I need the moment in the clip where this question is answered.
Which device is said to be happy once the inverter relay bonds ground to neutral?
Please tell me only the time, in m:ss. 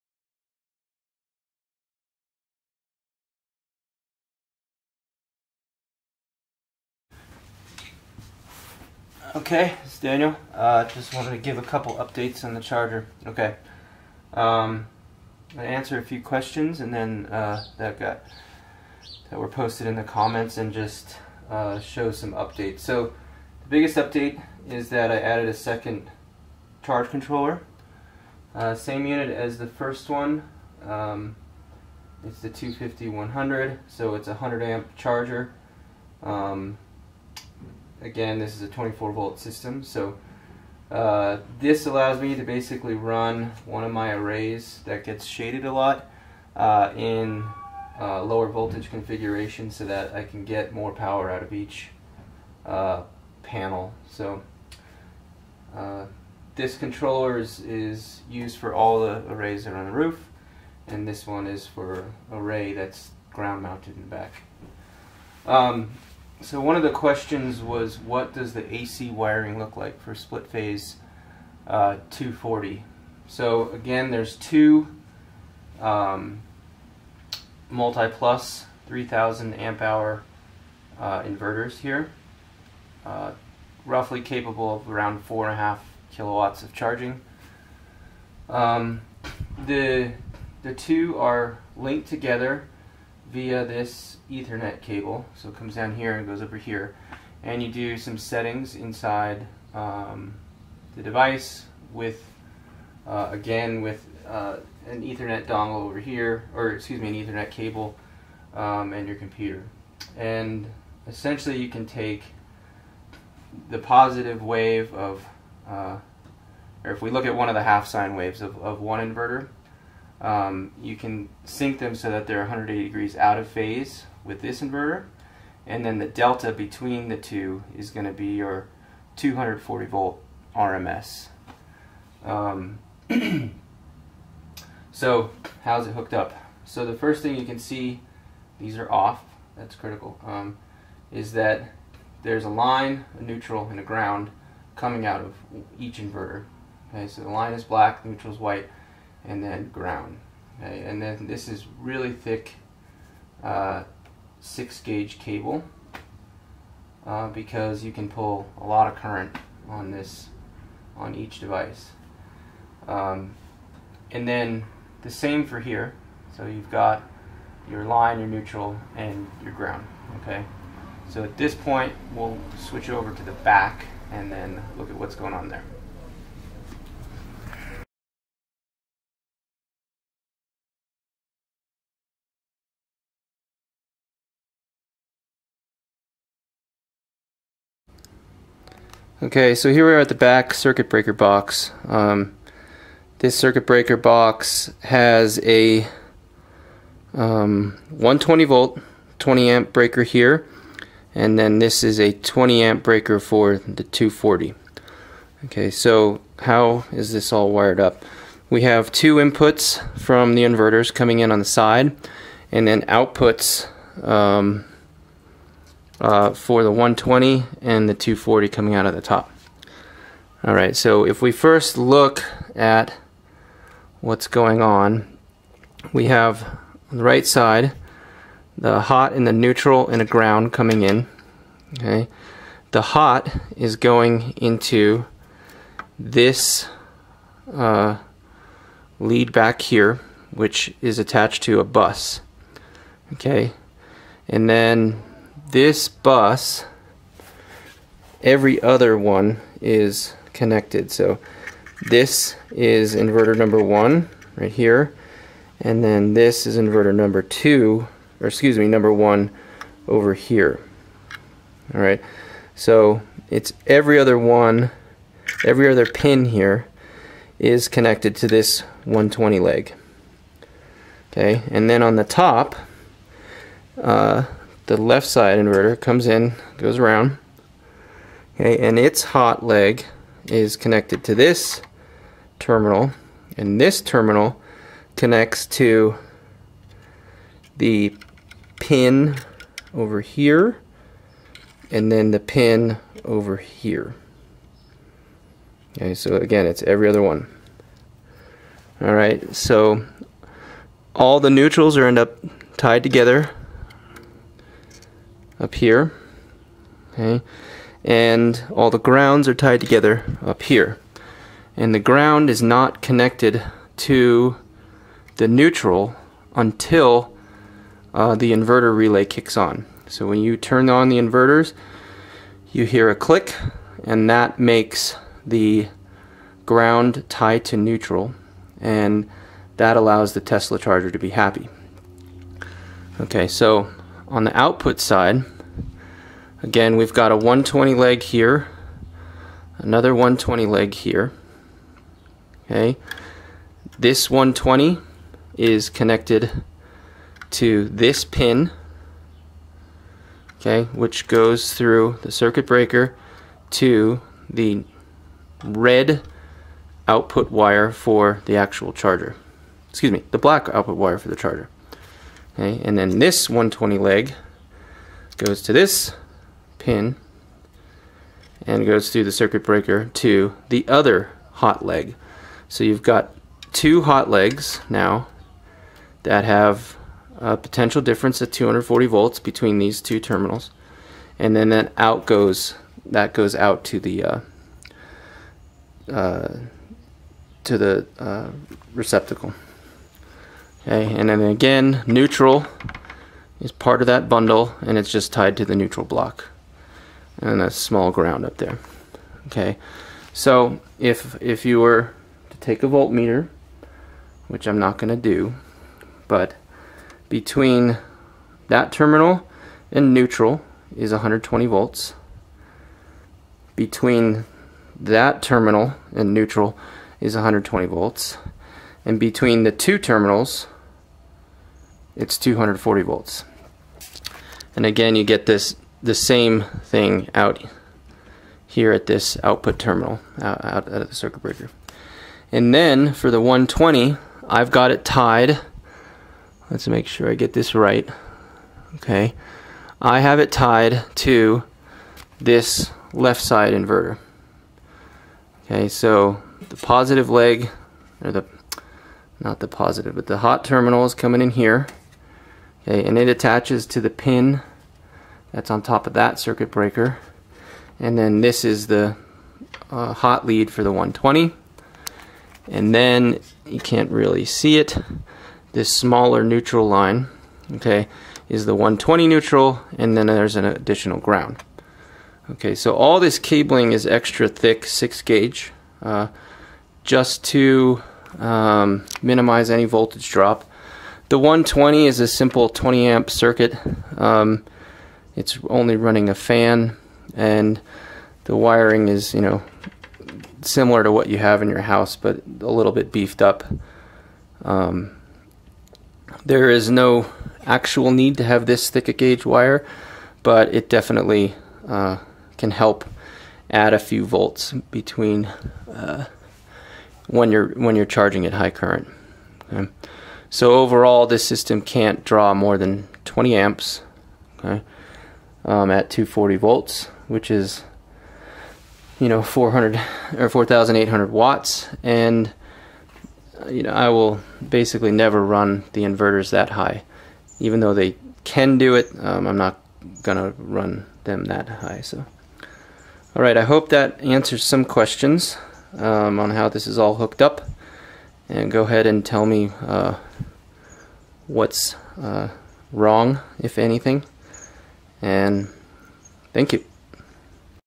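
5:30.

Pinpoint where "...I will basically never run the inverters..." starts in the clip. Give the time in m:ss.
8:43.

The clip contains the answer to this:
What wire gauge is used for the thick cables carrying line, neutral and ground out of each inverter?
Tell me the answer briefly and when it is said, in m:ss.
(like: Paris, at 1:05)
6 gauge, at 2:34.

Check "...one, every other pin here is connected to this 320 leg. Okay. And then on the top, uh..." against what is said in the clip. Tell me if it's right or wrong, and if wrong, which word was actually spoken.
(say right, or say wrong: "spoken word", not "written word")
wrong: "120", not "320".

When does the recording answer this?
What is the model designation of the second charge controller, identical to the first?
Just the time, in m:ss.
0:32.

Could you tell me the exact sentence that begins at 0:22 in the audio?
So the biggest update is that I added a second charge controller.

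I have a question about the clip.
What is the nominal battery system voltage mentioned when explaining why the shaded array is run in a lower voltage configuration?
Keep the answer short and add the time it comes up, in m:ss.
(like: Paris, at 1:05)
24 volt, at 0:38.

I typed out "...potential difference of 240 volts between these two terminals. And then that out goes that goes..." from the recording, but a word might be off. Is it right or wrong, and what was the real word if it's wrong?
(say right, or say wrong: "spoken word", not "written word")
right.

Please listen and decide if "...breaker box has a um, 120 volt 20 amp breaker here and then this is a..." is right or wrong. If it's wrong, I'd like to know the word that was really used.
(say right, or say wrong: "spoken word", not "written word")
right.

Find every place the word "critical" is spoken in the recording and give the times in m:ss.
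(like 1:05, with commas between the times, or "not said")
2:19.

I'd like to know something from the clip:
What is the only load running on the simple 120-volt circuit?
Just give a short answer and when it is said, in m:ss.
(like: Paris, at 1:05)
a fan, at 8:06.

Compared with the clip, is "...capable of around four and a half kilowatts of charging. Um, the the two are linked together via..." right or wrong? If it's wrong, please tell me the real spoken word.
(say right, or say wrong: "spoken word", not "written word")
right.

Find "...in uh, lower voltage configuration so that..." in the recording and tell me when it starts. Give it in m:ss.
0:46.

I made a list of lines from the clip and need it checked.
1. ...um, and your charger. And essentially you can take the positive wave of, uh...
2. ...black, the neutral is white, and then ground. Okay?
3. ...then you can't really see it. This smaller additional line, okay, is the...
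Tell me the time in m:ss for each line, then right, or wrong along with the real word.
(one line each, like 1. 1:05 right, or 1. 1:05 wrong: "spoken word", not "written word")
1. 1:48 wrong: "computer", not "charger"
2. 2:27 right
3. 7:42 wrong: "neutral", not "additional".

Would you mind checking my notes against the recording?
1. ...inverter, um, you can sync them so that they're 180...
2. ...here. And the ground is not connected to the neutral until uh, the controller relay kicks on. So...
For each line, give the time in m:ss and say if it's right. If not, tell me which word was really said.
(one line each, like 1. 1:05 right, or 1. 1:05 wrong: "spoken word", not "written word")
1. 1:58 right
2. 5:10 wrong: "inverter", not "controller".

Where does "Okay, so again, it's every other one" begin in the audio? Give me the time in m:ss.
4:55.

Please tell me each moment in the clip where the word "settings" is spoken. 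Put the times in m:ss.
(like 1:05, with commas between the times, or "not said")
1:38.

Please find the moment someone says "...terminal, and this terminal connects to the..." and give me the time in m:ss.
4:42.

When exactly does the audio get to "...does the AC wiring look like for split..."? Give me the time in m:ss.
1:08.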